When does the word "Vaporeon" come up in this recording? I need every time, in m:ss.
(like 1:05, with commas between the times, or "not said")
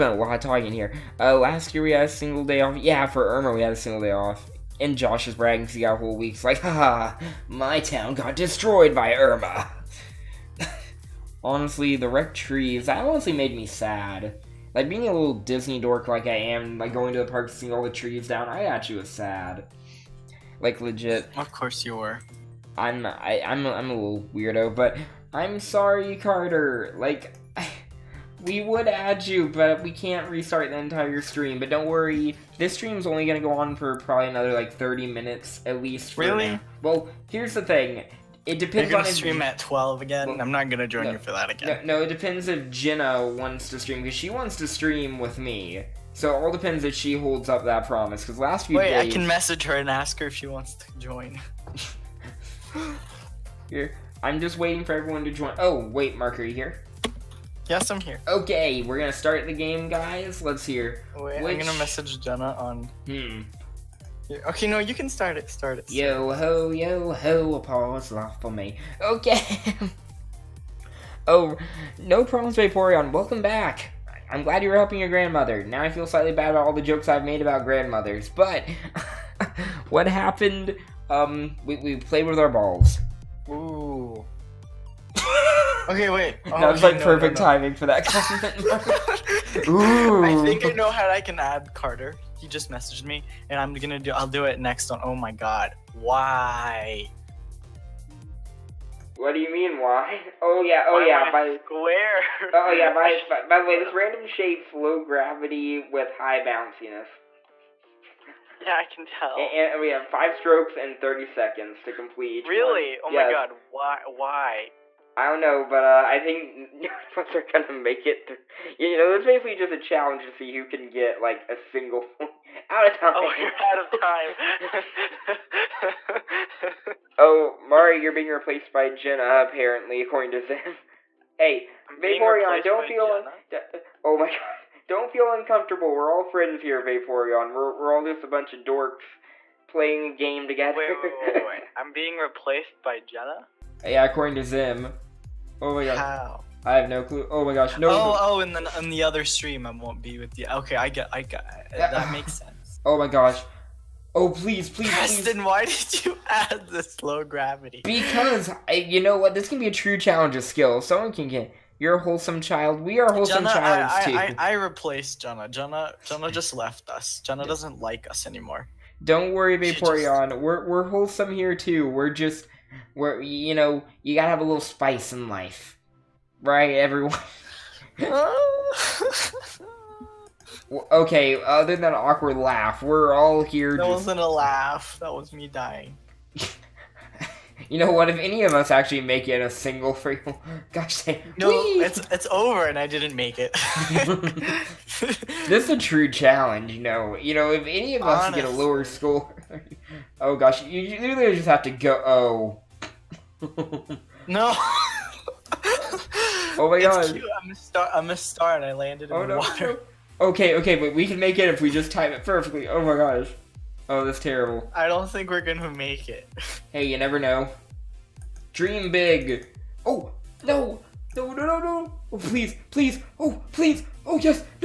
1:12, 2:11, 2:16, 2:49.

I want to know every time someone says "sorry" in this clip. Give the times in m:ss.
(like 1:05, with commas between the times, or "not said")
0:25.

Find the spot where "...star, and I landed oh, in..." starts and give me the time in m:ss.
3:28.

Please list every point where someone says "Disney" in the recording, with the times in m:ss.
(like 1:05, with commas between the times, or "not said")
0:15.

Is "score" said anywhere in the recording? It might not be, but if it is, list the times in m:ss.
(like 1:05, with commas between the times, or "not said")
3:18.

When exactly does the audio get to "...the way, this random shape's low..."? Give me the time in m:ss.
1:43.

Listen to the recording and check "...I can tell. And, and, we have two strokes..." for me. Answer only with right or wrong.
wrong.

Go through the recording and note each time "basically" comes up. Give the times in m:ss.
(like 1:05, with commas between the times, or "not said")
1:59.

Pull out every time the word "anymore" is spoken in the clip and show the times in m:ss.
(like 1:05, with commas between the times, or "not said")
2:48.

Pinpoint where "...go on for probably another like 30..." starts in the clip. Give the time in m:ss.
0:33.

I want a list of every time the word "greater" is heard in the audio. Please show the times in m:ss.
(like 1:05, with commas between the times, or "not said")
not said.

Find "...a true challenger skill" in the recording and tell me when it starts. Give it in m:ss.
2:39.